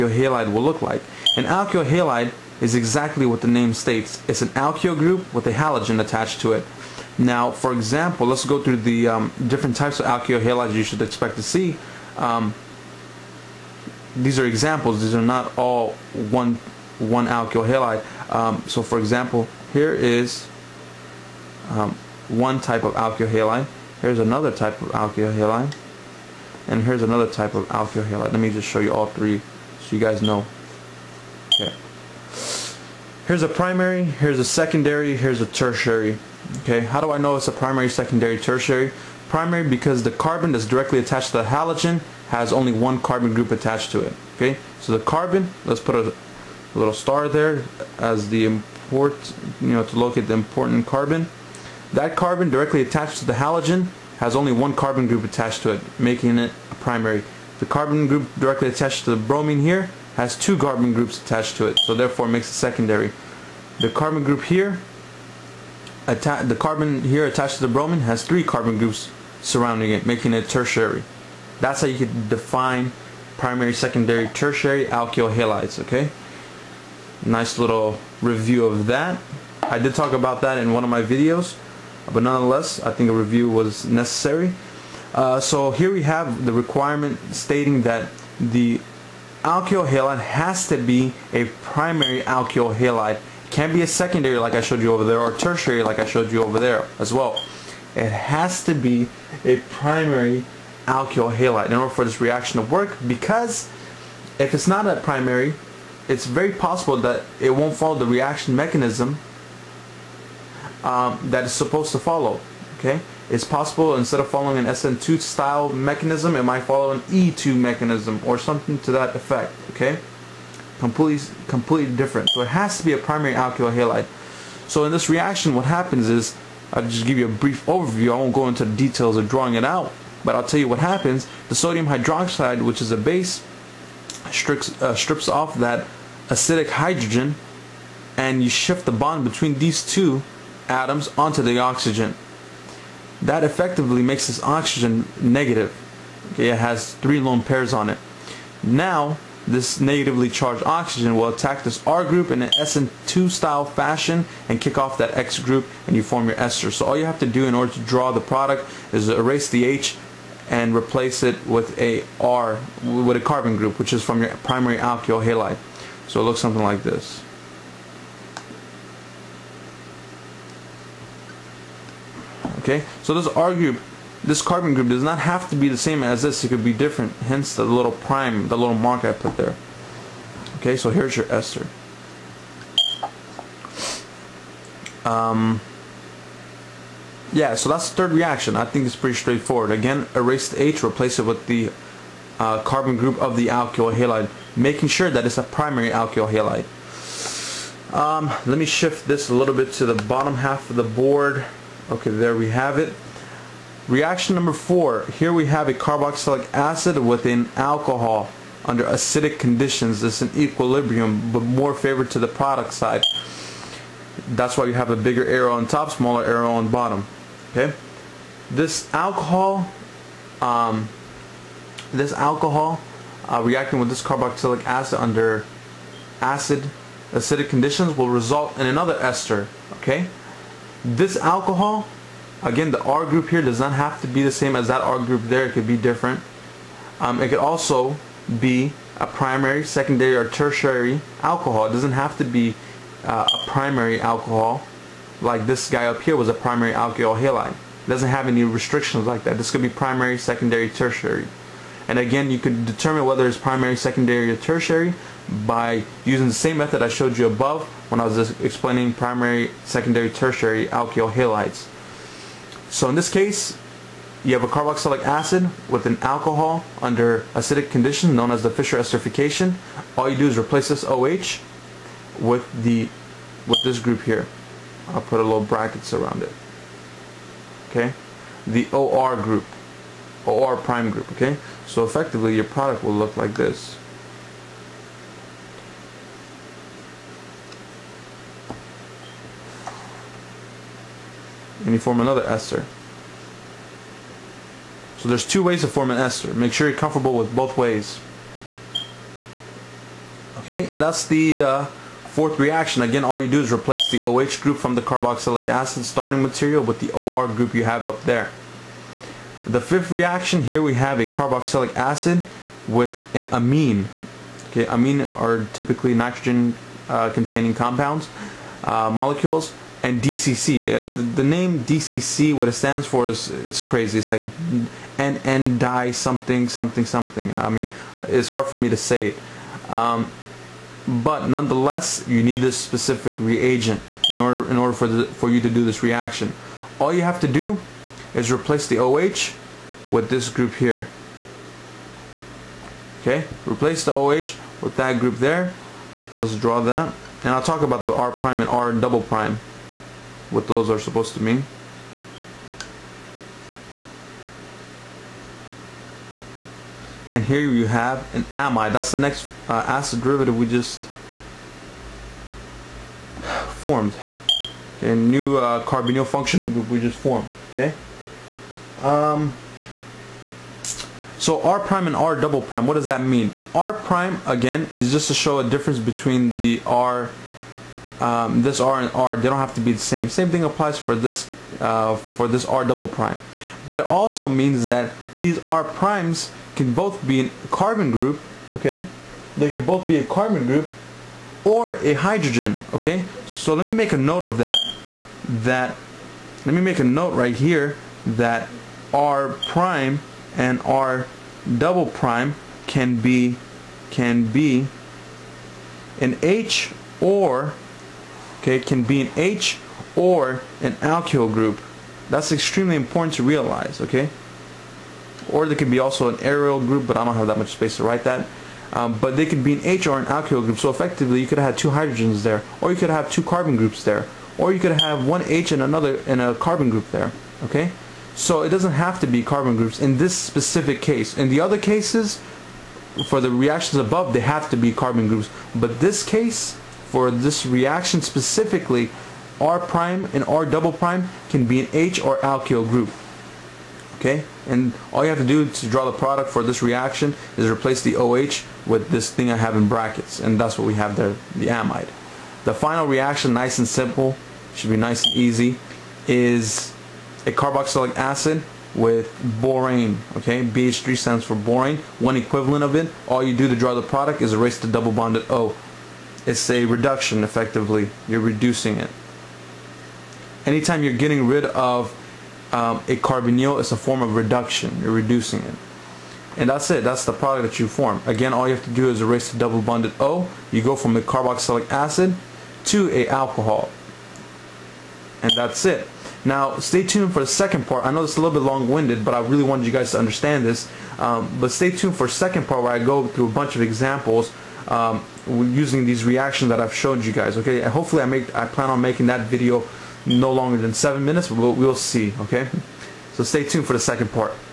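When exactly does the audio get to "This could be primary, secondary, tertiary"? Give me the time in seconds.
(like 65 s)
249 s.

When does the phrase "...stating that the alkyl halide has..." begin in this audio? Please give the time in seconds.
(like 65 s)
87 s.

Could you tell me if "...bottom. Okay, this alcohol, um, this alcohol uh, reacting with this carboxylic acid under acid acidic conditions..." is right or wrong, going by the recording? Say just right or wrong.
right.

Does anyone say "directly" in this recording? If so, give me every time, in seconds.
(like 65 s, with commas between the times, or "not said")
40 s, 52 s, 58 s.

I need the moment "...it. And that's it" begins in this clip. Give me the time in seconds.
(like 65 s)
475 s.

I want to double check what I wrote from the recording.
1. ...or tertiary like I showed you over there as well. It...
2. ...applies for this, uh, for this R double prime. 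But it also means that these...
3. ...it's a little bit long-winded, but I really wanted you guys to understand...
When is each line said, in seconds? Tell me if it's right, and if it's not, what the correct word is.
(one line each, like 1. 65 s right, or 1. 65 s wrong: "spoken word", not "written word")
1. 95 s right
2. 380 s right
3. 488 s right.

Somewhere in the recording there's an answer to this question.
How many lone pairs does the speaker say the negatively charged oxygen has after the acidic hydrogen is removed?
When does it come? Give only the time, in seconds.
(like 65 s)
146 s.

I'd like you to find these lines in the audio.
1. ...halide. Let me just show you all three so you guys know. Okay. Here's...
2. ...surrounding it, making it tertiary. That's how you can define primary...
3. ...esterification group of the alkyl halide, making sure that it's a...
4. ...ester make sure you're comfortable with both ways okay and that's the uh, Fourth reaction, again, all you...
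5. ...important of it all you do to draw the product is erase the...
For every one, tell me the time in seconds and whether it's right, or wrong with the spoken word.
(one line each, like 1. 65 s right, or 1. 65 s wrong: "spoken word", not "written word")
1. 28 s right
2. 69 s right
3. 192 s wrong: "carbon", not "esterification"
4. 295 s right
5. 462 s wrong: "equivalent", not "important".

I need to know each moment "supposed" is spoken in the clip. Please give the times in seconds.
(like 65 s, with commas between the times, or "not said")
111 s, 350 s.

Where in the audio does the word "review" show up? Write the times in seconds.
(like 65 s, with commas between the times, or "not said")
78 s, 83 s.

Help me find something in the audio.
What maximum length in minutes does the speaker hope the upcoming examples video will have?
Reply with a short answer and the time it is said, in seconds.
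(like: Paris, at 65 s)
7 minutes, at 500 s.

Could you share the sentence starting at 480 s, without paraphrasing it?
You go from a carboxylic acid to a alcohol.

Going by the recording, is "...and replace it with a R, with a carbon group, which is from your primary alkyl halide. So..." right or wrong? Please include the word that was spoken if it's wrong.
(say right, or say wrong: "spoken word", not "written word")
right.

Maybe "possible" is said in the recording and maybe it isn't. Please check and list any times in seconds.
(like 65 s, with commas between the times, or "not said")
106 s, 113 s.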